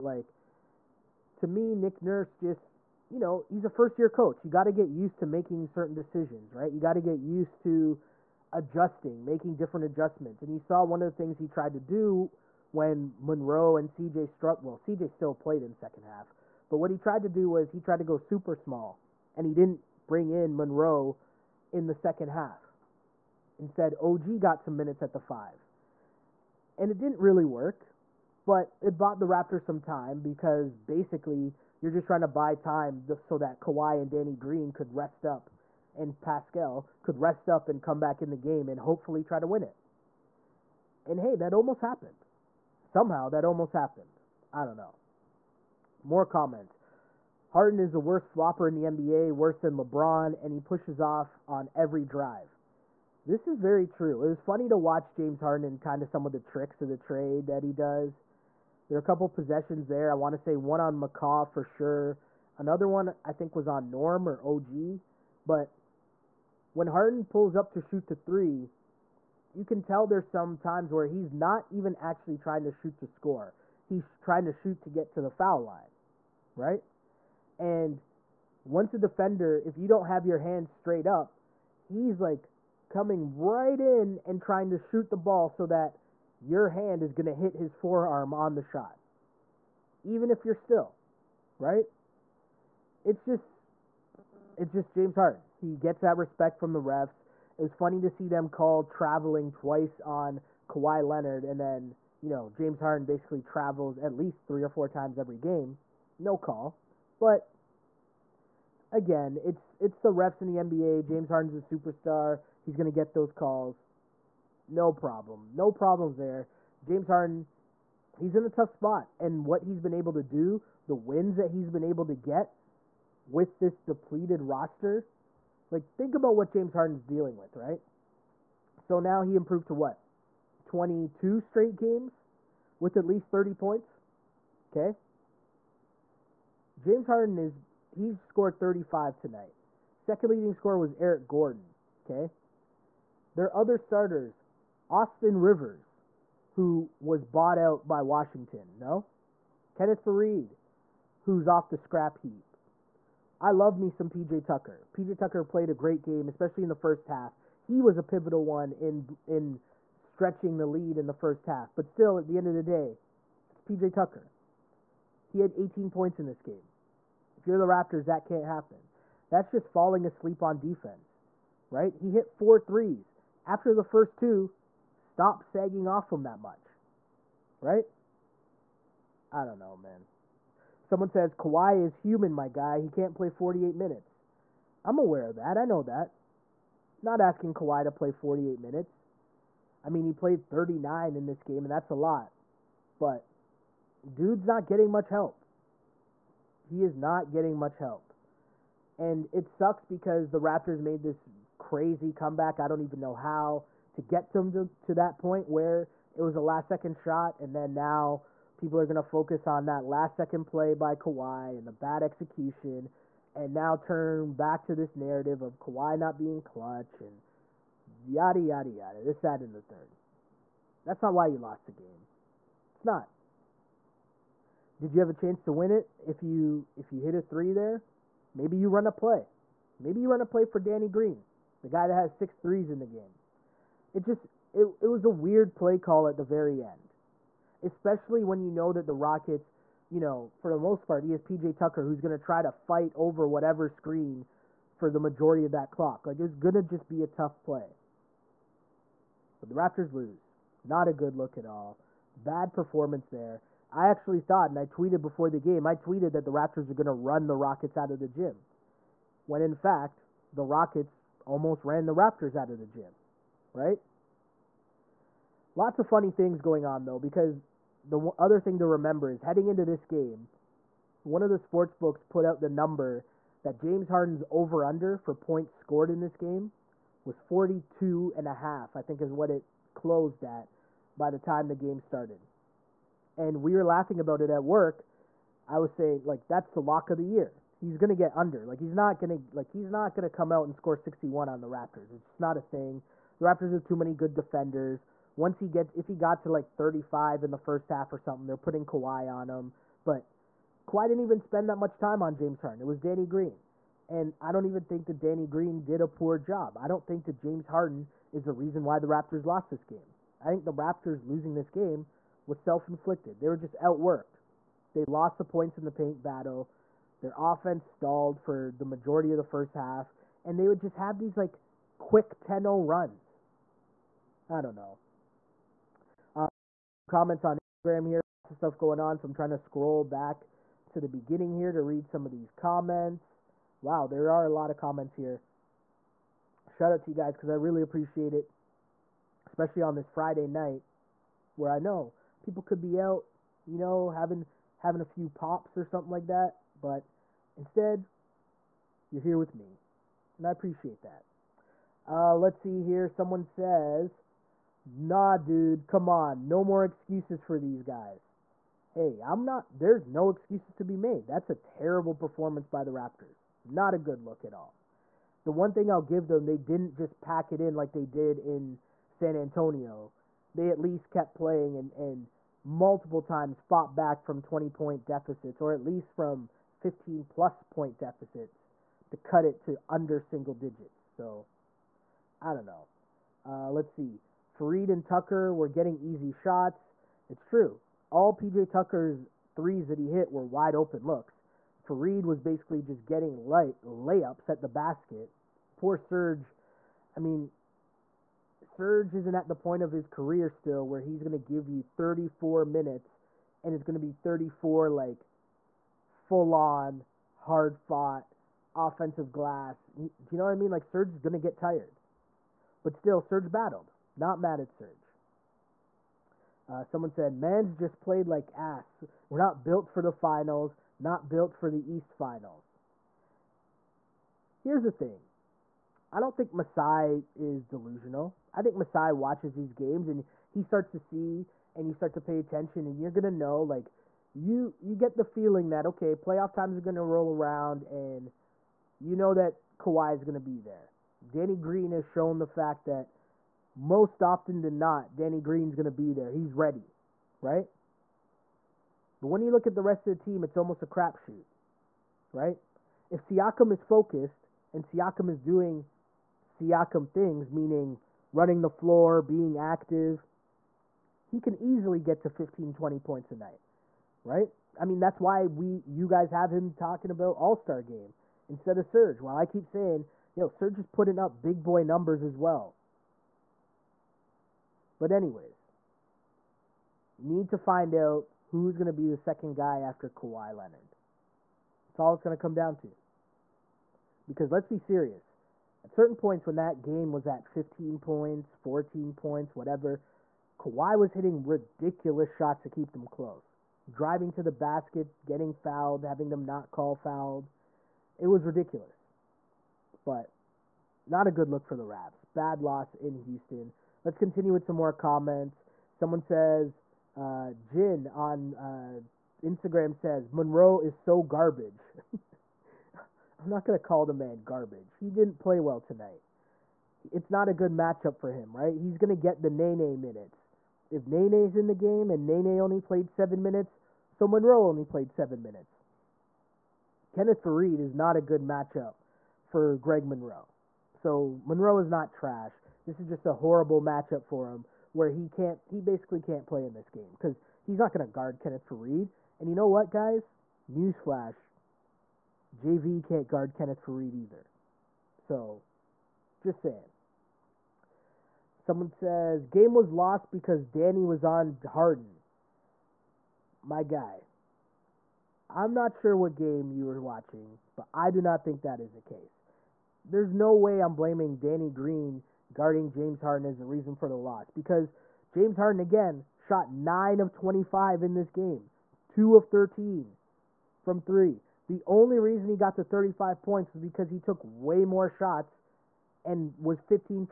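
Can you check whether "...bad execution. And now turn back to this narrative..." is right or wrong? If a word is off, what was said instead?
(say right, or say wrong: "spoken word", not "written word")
right.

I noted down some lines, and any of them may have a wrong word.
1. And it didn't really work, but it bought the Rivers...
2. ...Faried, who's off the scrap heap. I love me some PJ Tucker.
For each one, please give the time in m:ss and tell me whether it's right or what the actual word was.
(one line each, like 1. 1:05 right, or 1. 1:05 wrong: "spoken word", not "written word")
1. 0:26 wrong: "Raptors", not "Rivers"
2. 2:30 right.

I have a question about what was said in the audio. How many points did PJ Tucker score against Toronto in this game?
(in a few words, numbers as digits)
18.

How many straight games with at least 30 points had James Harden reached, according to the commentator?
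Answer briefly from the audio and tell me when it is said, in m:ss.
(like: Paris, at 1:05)
22, at 2:10.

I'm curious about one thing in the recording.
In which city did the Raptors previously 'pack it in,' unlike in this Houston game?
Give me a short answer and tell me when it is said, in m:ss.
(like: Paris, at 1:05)
San Antonio, at 6:08.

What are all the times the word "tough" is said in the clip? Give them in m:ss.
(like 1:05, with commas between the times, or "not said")
1:58, 4:07.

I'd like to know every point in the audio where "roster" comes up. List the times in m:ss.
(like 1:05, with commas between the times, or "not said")
2:04.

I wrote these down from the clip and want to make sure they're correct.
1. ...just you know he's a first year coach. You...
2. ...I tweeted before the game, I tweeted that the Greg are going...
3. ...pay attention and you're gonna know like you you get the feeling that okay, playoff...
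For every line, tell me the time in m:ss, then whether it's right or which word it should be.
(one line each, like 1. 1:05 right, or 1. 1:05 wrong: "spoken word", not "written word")
1. 0:02 right
2. 4:14 wrong: "Raptors", not "Greg"
3. 7:12 right.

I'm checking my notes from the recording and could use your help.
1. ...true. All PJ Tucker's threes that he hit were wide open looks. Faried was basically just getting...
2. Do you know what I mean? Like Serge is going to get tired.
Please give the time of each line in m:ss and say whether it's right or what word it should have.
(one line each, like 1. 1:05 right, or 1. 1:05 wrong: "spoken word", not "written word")
1. 6:27 right
2. 6:49 right.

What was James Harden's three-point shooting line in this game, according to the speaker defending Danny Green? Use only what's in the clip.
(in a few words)
2 of 13.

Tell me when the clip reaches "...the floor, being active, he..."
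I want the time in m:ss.
7:38.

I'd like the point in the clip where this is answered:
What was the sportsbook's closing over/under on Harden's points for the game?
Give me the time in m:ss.
4:37.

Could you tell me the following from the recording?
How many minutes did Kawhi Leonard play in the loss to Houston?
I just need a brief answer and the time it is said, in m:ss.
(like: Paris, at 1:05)
39, at 3:10.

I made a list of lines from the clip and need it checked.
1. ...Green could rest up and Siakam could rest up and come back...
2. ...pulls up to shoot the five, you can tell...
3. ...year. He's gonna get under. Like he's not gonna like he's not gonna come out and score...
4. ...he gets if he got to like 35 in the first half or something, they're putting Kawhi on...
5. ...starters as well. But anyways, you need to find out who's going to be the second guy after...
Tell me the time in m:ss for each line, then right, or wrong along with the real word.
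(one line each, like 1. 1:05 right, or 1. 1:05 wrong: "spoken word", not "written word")
1. 0:34 wrong: "Pascal", not "Siakam"
2. 1:07 wrong: "three", not "five"
3. 4:47 right
4. 4:55 right
5. 7:51 wrong: "numbers", not "starters".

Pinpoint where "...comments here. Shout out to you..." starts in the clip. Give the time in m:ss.
5:34.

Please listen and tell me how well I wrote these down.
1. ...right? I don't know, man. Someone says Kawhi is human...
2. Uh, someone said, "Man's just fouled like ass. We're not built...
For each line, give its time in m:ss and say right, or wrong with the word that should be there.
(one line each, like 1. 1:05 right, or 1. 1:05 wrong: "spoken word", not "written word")
1. 2:57 right
2. 6:56 wrong: "played", not "fouled".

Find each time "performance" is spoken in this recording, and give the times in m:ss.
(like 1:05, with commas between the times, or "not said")
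4:12, 6:01.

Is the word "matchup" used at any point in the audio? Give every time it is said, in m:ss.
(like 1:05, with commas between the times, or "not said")
8:37, 8:48, 8:53.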